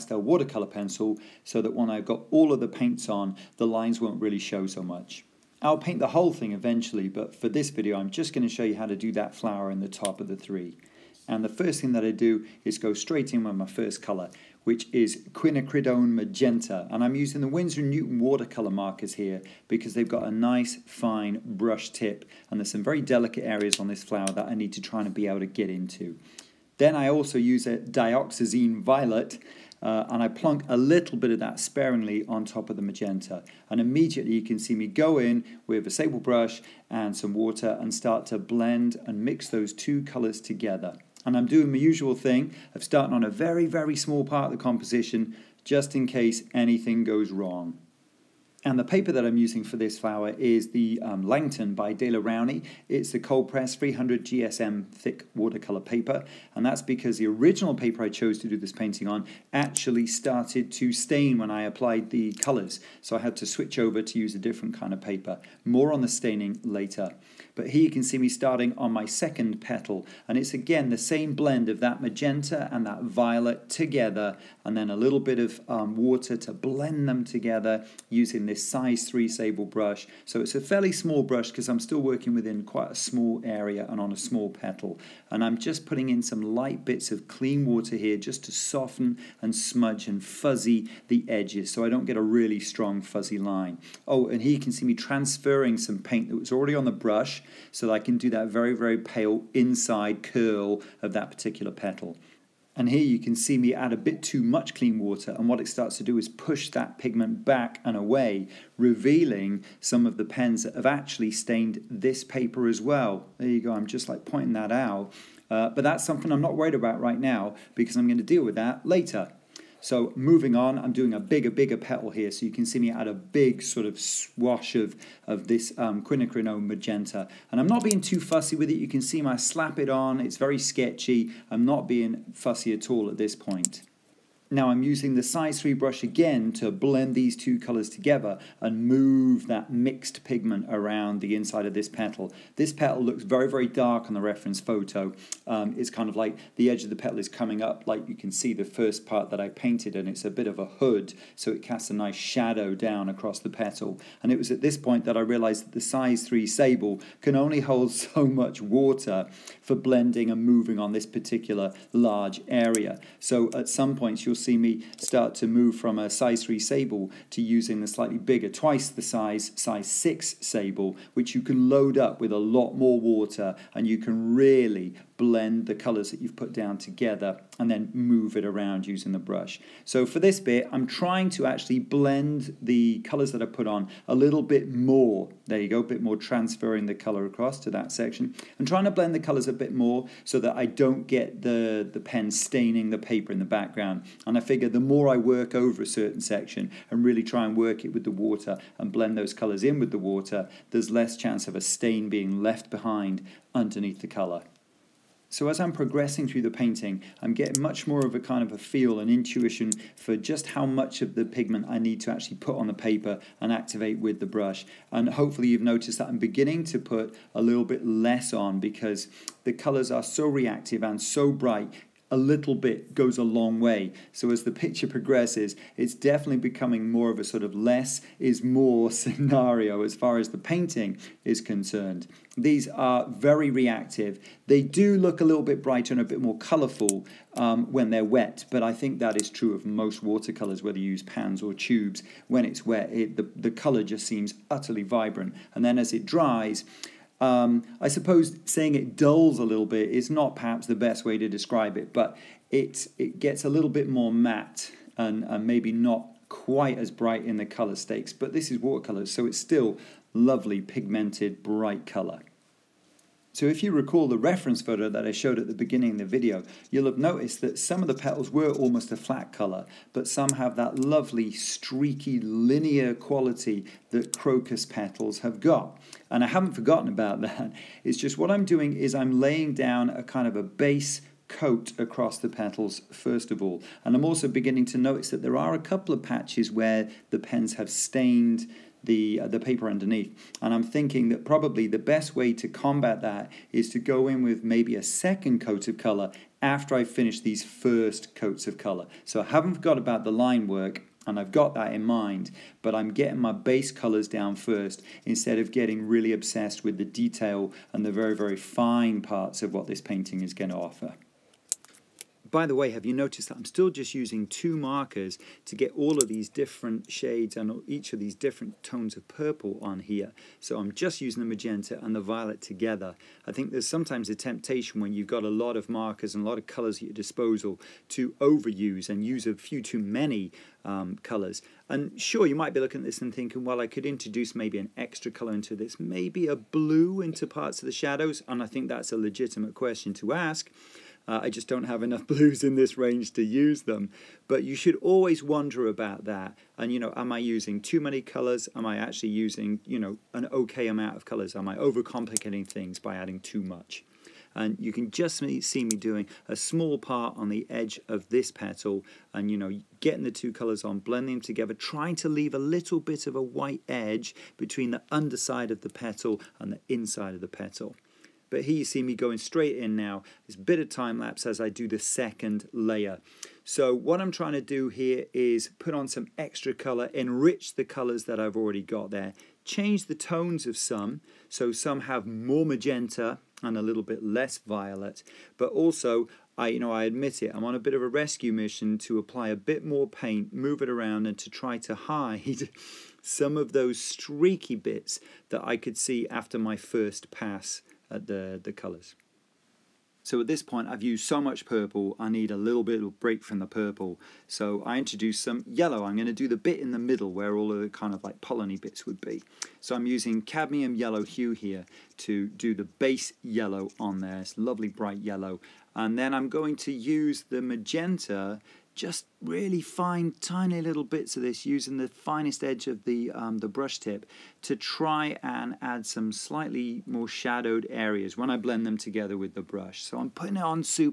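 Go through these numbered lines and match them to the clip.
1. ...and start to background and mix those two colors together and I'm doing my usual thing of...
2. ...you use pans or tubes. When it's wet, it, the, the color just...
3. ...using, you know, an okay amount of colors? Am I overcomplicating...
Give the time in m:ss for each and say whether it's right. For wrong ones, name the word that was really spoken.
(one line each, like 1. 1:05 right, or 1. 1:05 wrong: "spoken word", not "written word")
1. 0:37 wrong: "blend", not "background"
2. 4:00 right
3. 5:49 right.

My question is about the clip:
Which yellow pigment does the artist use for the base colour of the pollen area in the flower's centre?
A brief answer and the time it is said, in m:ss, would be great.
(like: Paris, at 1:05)
cadmium yellow hue, at 6:50.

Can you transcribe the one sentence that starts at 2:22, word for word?
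This petal looks very, very dark on the reference photo.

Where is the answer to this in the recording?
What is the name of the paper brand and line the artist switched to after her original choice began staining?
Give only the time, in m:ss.
0:51.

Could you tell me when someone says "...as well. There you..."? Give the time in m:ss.
1:52.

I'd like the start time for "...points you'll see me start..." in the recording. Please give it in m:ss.
2:43.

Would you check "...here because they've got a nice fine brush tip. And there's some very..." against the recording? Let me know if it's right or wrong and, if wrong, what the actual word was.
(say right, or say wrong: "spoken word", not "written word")
right.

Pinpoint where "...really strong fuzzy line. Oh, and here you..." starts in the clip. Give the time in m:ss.
1:32.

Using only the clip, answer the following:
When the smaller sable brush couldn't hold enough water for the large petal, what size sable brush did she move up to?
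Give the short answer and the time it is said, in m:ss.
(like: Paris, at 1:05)
6, at 2:49.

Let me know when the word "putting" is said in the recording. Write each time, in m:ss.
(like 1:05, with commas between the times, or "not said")
1:25, 7:10.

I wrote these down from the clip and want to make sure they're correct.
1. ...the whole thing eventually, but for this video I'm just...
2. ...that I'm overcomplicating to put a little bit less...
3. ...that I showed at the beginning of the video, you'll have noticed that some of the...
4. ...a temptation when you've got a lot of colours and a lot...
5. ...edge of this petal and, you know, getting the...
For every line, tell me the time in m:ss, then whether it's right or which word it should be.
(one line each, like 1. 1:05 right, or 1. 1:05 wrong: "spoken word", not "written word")
1. 0:06 right
2. 3:35 wrong: "beginning", not "overcomplicating"
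3. 4:24 right
4. 5:24 wrong: "markers", not "colours"
5. 5:57 right.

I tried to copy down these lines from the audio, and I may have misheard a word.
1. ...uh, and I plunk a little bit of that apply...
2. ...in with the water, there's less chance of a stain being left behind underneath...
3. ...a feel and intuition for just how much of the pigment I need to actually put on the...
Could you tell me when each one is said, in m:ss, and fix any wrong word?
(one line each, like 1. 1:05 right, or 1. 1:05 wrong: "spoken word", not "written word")
1. 0:29 wrong: "sparingly", not "apply"
2. 3:19 right
3. 3:28 right.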